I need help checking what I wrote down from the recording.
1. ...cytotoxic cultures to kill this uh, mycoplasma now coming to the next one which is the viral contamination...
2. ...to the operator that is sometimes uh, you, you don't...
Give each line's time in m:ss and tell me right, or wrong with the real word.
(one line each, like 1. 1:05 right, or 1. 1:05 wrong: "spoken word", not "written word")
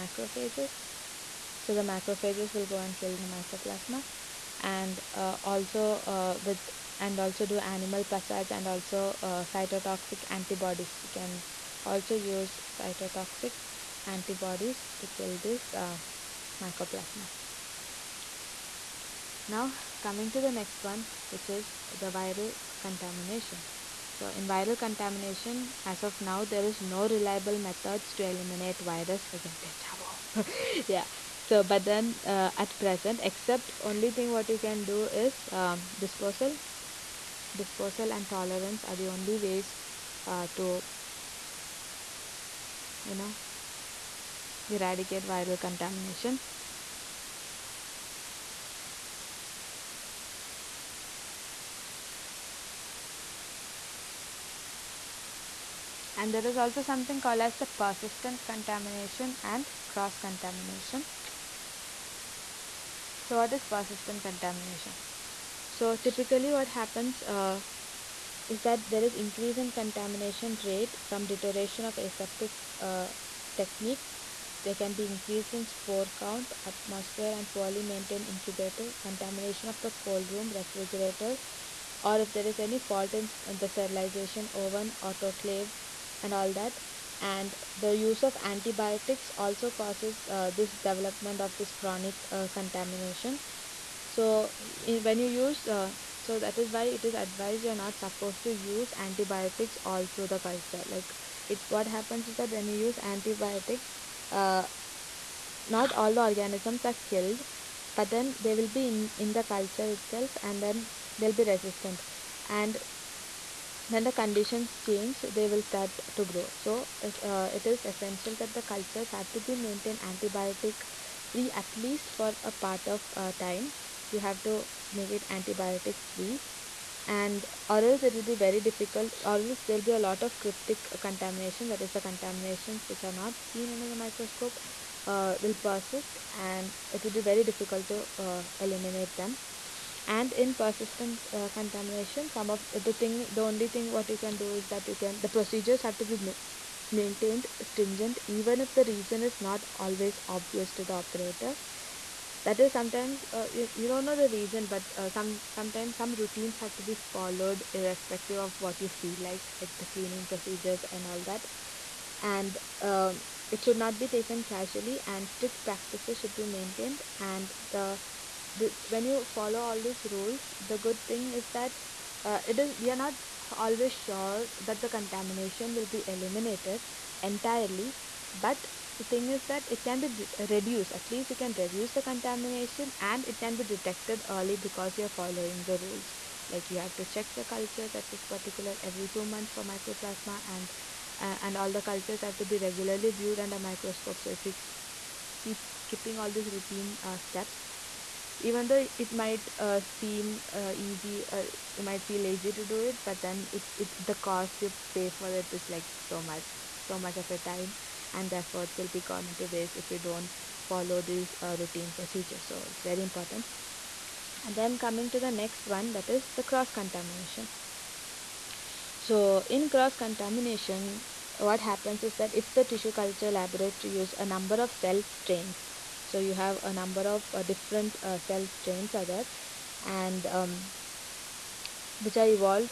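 1. 0:12 wrong: "antibodies", not "cultures"
2. 2:30 right.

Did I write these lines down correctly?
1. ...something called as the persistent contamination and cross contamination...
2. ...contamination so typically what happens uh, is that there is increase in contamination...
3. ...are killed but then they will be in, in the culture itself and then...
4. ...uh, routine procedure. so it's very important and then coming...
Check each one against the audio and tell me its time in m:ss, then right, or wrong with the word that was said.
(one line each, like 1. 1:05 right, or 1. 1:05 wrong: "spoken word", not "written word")
1. 0:56 right
2. 1:04 right
3. 1:46 right
4. 3:31 right.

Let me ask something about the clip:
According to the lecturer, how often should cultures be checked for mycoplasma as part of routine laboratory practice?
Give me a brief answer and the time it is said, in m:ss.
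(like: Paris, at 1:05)
Every 2 months, at 3:08.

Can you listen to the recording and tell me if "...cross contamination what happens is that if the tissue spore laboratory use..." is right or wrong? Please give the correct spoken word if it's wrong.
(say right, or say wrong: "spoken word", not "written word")
wrong: "culture", not "spore".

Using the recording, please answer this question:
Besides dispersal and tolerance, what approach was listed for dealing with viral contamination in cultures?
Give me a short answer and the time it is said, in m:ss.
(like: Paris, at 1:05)
Disposal, at 0:35.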